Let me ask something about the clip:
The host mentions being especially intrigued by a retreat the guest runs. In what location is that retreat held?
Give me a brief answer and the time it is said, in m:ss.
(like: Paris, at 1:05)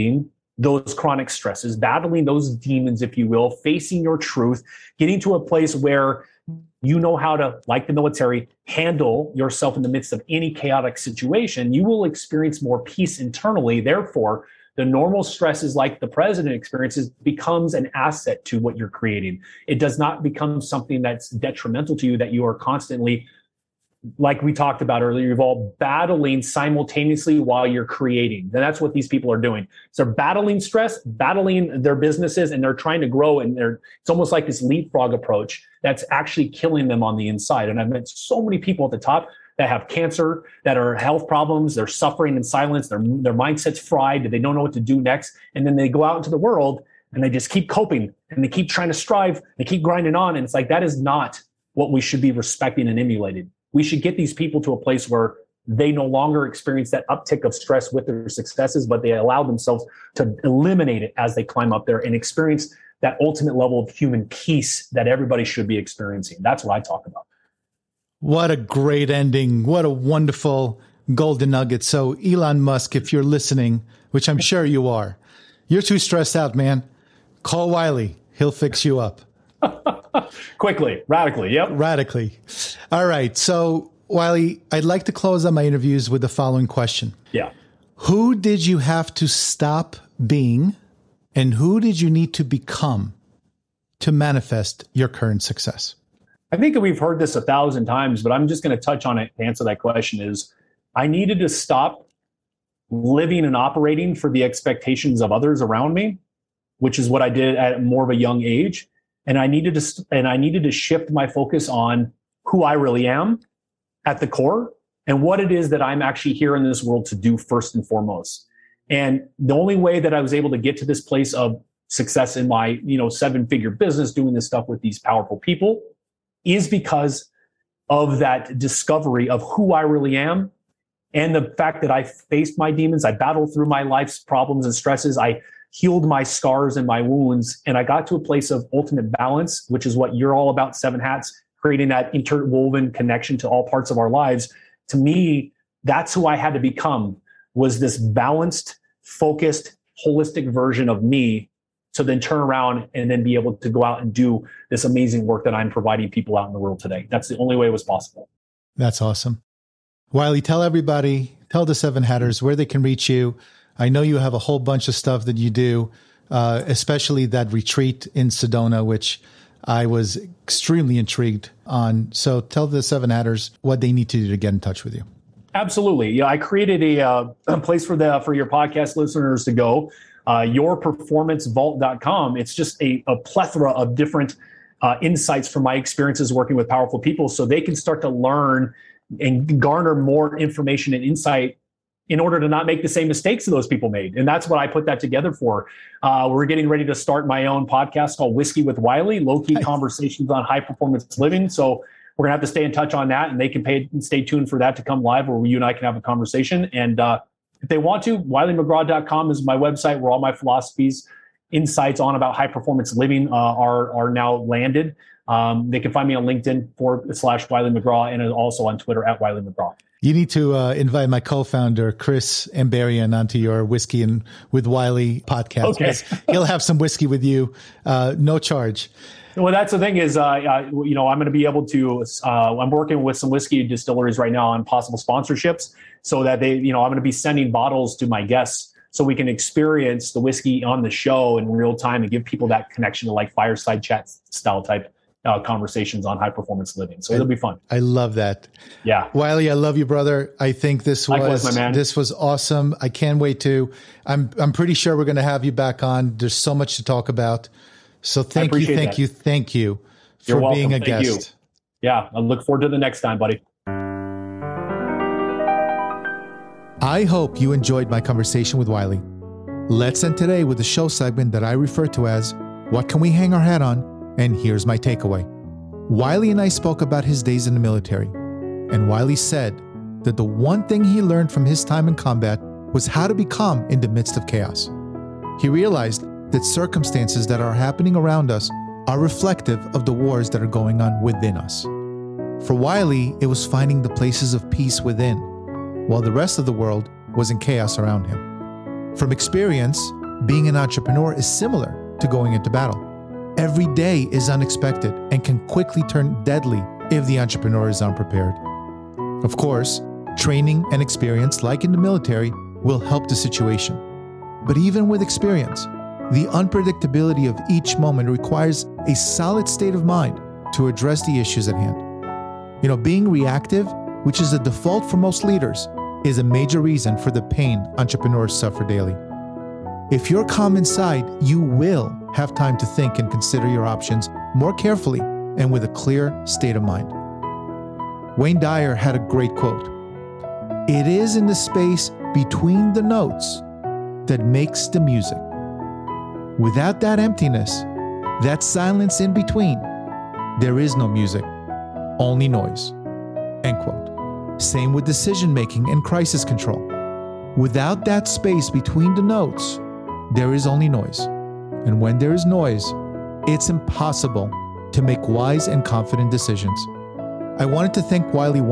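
Sedona, at 2:48.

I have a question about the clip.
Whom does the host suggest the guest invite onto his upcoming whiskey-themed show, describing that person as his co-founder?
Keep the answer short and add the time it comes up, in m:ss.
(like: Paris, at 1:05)
Chris Ambarian, at 3:41.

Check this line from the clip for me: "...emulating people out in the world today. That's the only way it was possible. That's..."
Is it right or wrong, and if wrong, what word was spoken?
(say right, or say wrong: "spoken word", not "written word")
wrong: "providing", not "emulating".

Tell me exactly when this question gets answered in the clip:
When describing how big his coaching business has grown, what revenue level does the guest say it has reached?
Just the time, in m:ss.
2:03.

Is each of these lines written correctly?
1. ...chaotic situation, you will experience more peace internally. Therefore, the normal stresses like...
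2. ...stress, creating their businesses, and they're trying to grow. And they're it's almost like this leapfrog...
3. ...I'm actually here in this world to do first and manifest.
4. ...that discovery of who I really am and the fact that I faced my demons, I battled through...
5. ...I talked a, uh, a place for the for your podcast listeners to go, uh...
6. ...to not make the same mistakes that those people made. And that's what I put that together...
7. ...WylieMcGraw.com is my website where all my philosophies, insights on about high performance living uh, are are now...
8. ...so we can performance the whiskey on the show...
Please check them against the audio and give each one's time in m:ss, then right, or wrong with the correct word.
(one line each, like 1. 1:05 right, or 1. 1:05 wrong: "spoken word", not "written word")
1. 0:10 right
2. 0:30 wrong: "battling", not "creating"
3. 1:55 wrong: "foremost", not "manifest"
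4. 2:08 right
5. 2:56 wrong: "created", not "talked"
6. 3:12 right
7. 3:28 right
8. 3:58 wrong: "experience", not "performance".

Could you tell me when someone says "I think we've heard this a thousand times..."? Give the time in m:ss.
1:36.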